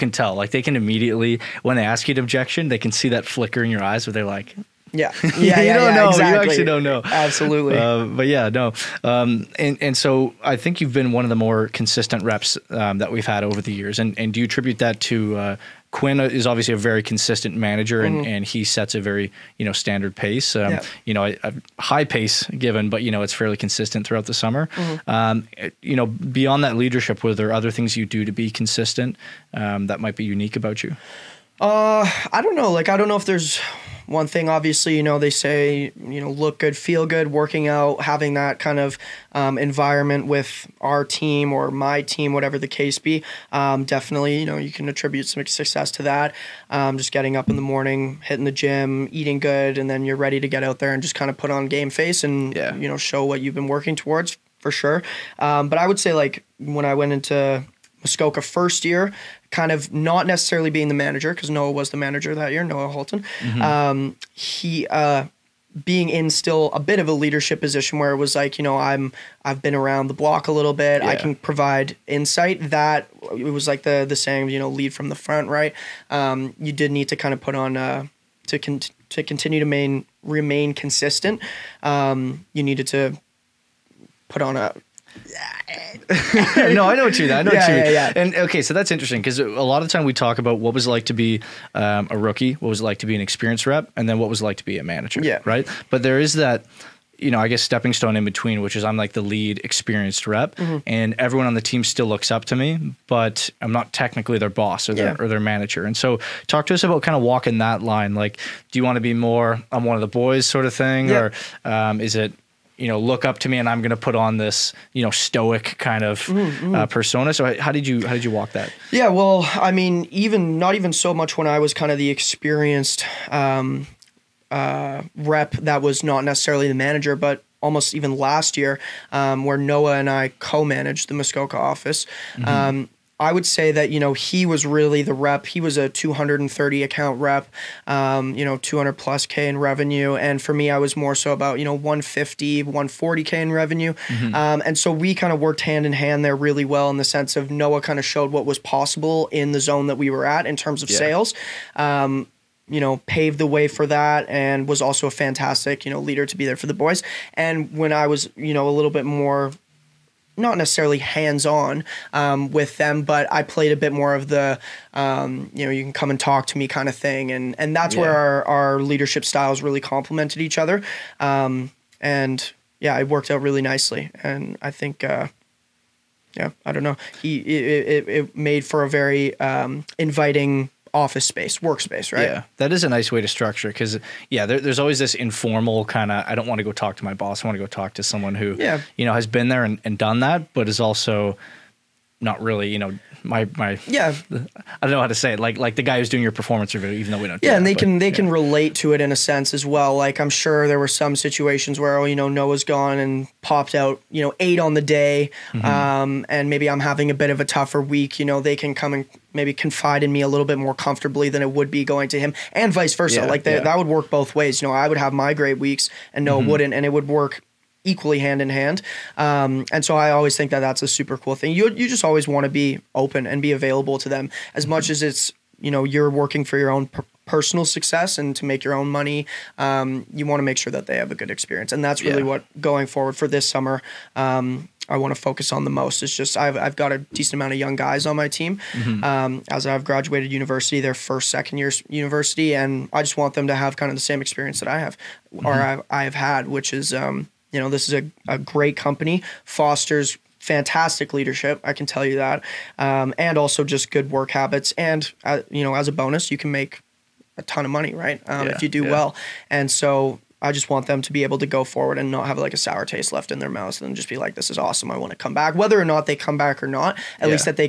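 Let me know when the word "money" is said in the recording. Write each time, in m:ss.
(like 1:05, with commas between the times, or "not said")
3:48, 4:17.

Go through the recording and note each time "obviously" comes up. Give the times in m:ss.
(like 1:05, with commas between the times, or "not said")
0:16, 0:34.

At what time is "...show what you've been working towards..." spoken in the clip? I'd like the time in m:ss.
0:52.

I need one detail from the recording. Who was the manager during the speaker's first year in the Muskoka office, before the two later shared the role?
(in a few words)
Noah Halton.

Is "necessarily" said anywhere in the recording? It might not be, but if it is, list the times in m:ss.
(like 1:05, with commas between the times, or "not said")
1:00, 2:06, 2:40.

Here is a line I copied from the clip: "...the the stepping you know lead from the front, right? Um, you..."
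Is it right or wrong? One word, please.
wrong.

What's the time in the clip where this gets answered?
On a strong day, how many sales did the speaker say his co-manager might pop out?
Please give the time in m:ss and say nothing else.
3:24.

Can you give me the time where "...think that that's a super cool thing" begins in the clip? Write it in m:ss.
3:40.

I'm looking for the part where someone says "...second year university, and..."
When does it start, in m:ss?
4:01.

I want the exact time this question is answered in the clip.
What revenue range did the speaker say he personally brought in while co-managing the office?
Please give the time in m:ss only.
2:21.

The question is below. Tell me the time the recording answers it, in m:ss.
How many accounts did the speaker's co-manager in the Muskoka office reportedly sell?
2:15.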